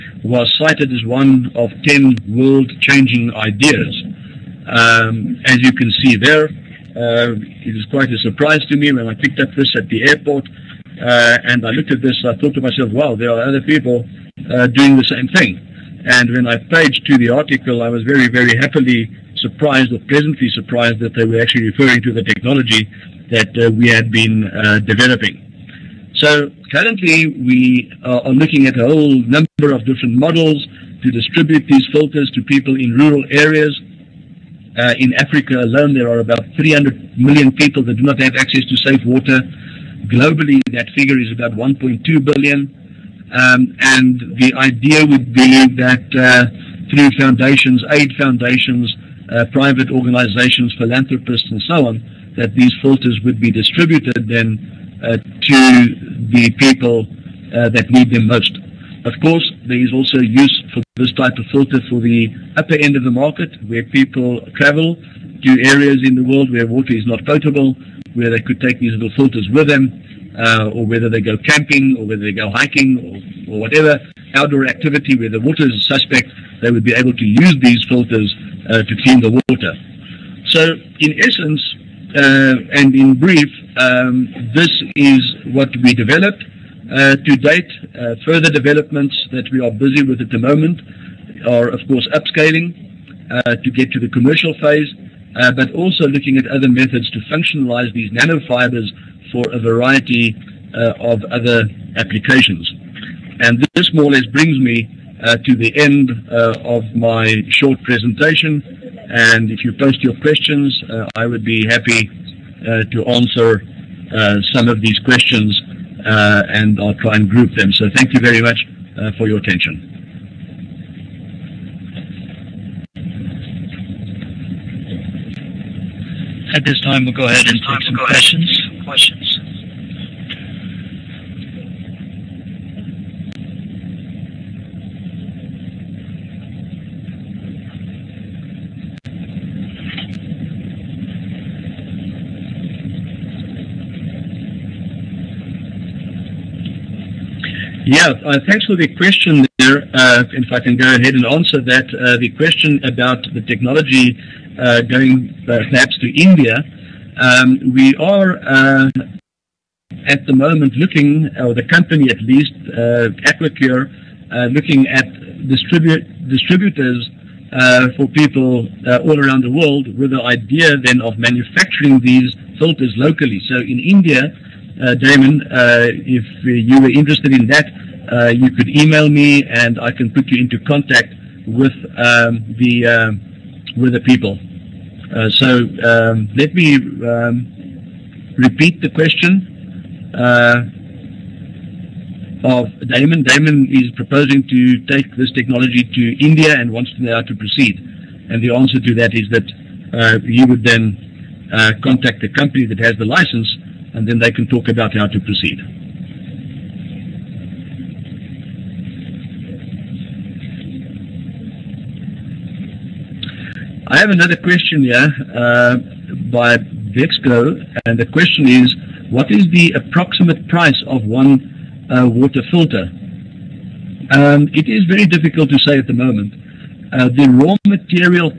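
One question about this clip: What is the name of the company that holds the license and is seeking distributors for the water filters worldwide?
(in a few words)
Aquacure.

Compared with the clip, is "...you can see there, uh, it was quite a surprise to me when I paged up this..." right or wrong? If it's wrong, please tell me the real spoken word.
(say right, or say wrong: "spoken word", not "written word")
wrong: "picked", not "paged".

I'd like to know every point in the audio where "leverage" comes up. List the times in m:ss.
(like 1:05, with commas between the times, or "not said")
not said.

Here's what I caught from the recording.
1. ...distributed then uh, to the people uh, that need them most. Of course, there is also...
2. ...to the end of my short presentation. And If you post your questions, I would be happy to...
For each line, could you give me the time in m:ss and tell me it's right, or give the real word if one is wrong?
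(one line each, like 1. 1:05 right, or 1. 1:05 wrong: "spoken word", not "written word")
1. 0:53 right
2. 1:45 right.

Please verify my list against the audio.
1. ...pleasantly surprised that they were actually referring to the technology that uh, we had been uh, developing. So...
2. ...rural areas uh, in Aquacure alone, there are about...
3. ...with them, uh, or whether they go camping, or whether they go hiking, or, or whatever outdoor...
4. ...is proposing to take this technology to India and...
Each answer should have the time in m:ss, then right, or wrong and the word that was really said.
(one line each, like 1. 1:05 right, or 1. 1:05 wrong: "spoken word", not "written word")
1. 0:20 right
2. 0:32 wrong: "Africa", not "Aquacure"
3. 1:09 right
4. 3:13 right.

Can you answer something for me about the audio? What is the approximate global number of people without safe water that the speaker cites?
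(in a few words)
1.2 billion.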